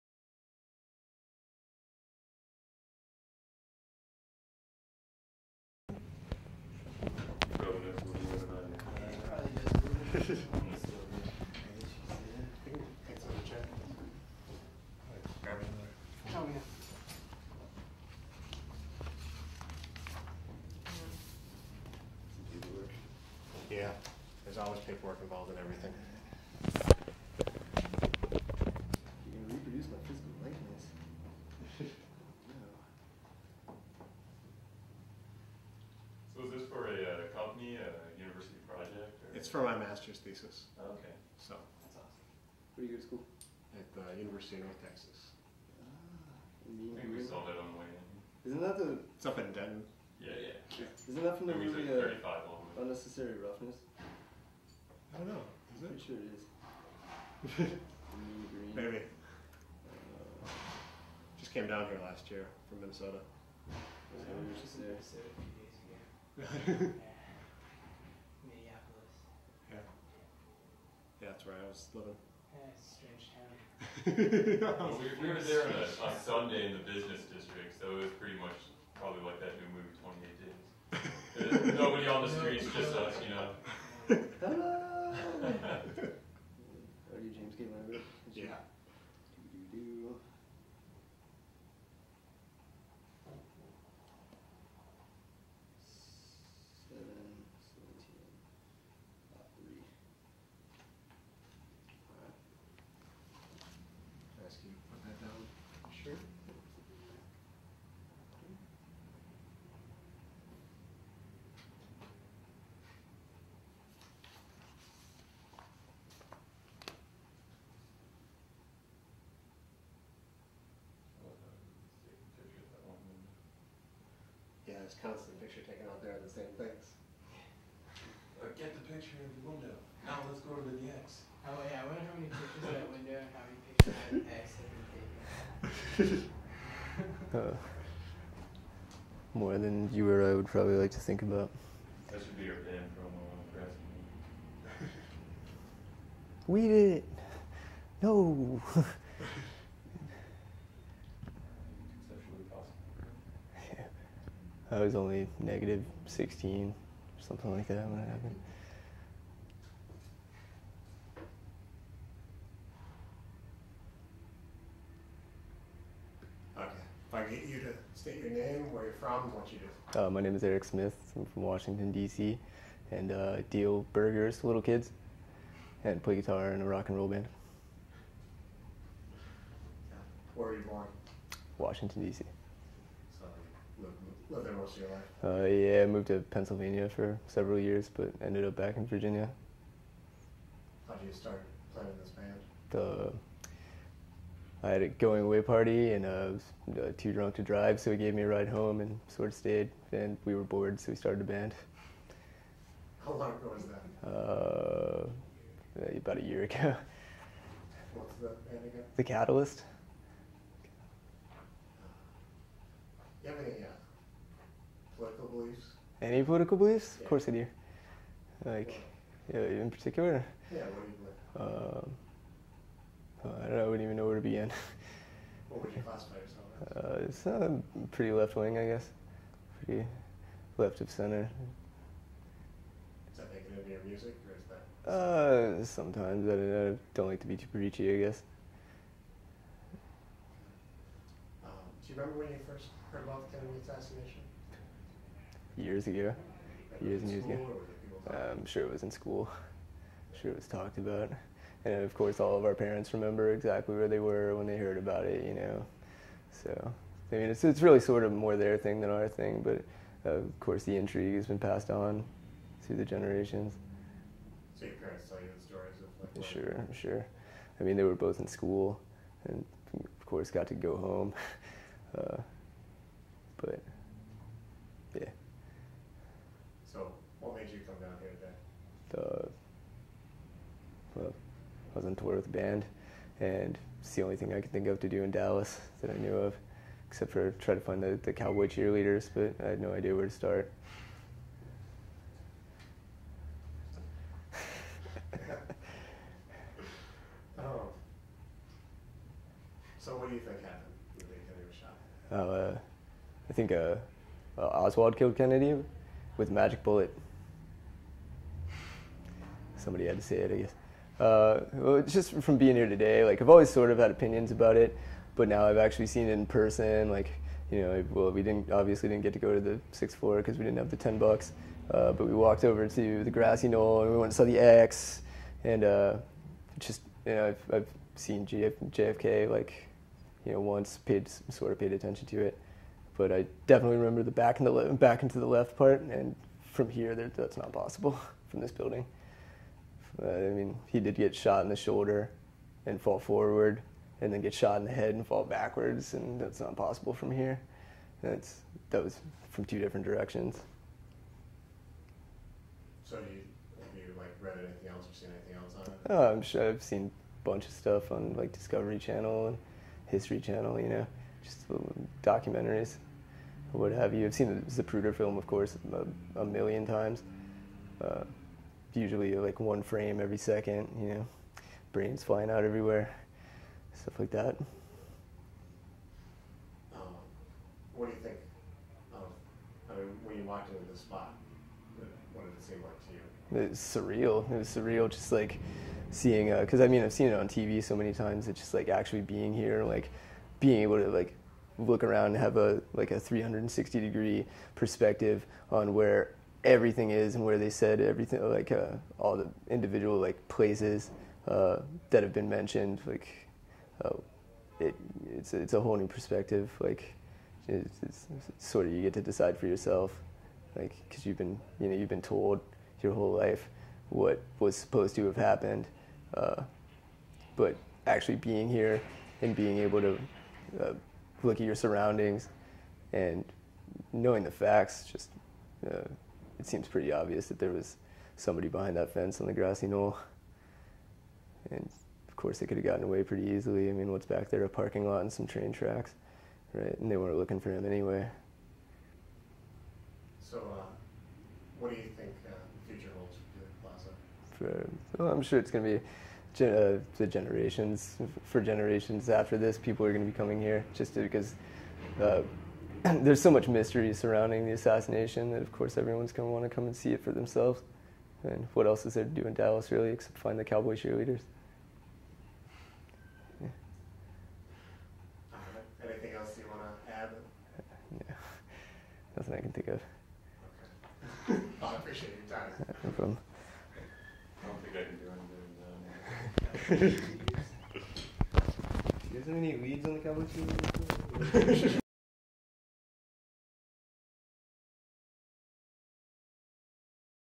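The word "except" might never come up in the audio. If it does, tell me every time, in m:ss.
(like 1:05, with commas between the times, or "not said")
4:46, 7:39.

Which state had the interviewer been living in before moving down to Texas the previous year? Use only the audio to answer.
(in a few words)
Minnesota.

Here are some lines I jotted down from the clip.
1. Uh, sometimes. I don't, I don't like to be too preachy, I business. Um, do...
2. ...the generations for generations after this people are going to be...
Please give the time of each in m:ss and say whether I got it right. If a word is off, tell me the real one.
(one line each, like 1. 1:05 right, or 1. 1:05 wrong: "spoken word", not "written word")
1. 3:54 wrong: "guess", not "business"
2. 7:26 right.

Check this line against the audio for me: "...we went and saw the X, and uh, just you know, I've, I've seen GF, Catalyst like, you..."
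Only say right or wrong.
wrong.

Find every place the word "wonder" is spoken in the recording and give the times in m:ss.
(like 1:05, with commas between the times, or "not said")
2:11.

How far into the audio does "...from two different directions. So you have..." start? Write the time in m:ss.
5:49.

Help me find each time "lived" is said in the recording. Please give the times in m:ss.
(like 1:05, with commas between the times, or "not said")
3:04.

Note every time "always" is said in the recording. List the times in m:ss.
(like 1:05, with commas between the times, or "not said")
0:24, 5:13.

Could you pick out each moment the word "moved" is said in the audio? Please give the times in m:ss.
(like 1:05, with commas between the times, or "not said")
3:05.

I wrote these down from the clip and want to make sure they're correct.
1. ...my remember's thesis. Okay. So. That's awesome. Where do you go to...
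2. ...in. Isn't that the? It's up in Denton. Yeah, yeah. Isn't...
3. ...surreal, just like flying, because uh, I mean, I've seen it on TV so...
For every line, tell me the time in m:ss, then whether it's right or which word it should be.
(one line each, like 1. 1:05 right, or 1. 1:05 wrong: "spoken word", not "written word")
1. 0:39 wrong: "master", not "remember"
2. 0:47 right
3. 6:24 wrong: "seeing", not "flying".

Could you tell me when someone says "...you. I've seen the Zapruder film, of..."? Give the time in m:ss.
6:03.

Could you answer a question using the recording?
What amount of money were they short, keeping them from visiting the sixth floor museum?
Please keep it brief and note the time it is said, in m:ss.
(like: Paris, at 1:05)
$10, at 5:20.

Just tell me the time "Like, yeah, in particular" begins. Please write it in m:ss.
3:38.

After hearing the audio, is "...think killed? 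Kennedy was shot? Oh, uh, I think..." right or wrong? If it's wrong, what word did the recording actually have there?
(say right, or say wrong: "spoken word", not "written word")
wrong: "happened", not "killed".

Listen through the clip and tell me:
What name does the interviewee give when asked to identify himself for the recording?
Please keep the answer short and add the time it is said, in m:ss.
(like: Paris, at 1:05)
Eric Smith, at 2:50.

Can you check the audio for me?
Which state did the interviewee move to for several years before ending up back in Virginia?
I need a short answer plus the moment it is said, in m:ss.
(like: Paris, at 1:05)
Pennsylvania, at 3:06.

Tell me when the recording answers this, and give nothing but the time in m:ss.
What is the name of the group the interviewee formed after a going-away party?
3:28.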